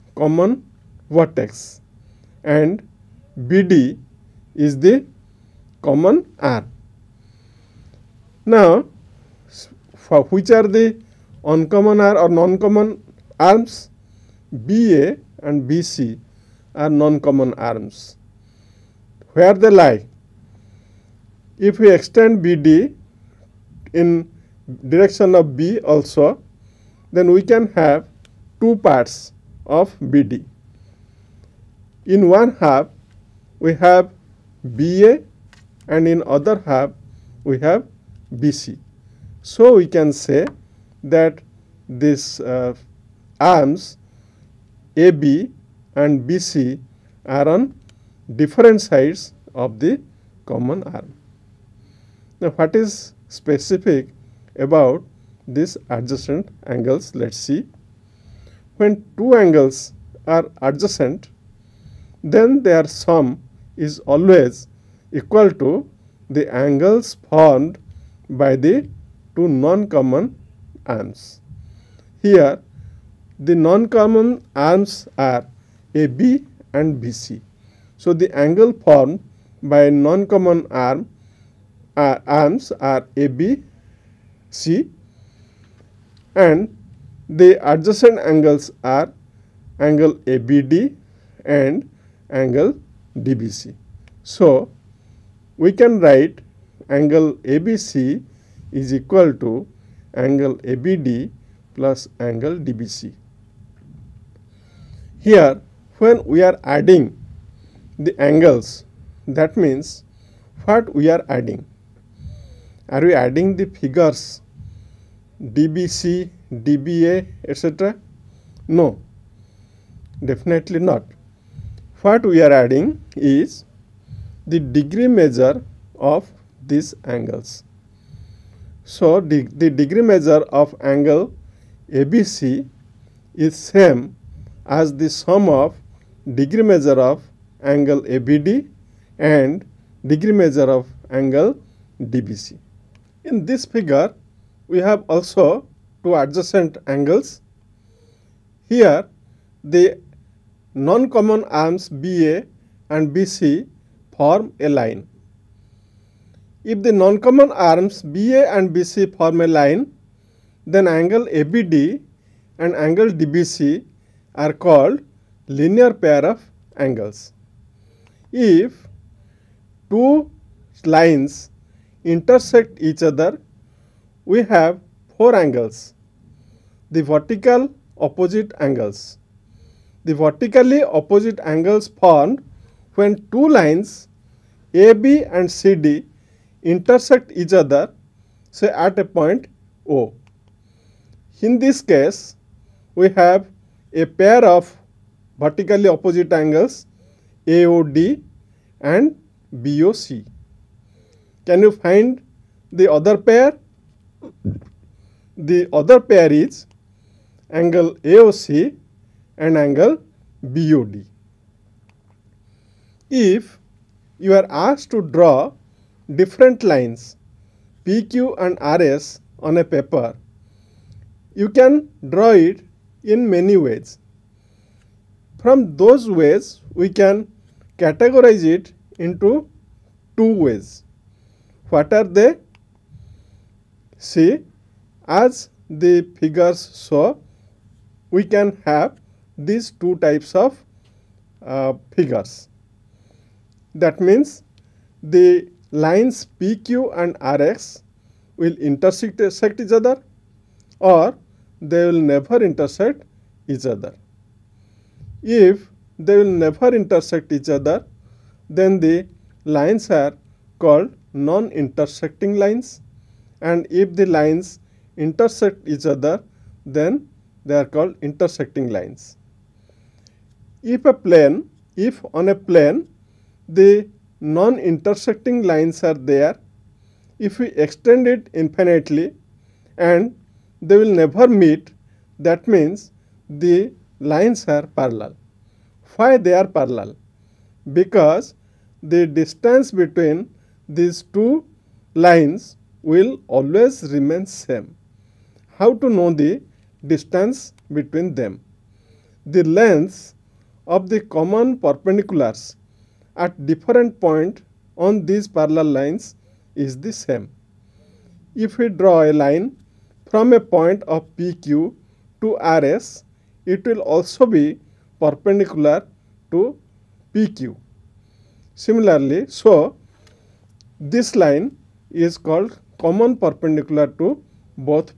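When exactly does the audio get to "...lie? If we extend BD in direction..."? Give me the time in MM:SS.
00:19.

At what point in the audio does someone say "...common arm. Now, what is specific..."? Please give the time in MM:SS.
00:50.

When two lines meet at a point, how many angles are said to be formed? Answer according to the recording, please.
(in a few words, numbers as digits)
4.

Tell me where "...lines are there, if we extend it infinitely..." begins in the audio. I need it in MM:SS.
04:35.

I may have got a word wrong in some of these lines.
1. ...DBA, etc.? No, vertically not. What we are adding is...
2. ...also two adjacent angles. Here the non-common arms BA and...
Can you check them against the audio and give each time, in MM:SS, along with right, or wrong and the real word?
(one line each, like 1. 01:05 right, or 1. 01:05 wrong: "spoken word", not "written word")
1. 01:56 wrong: "definitely", not "vertically"
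2. 02:25 right.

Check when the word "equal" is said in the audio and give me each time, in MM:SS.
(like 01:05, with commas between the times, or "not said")
01:05, 01:38.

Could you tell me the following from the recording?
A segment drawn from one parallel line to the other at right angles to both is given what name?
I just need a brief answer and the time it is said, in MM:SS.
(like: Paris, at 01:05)
common perpendicular, at 05:22.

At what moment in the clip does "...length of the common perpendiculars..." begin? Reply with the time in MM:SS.
04:59.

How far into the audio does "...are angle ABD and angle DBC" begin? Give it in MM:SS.
01:28.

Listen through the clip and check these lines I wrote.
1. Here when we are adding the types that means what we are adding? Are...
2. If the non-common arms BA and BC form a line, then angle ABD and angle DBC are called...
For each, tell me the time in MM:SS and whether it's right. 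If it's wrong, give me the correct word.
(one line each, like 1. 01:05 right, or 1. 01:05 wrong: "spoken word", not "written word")
1. 01:45 wrong: "angles", not "types"
2. 02:36 right.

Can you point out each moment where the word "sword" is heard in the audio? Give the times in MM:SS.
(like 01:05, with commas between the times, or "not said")
not said.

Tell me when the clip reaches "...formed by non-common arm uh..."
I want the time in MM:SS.
01:18.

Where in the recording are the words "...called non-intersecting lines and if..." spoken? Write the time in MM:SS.
04:20.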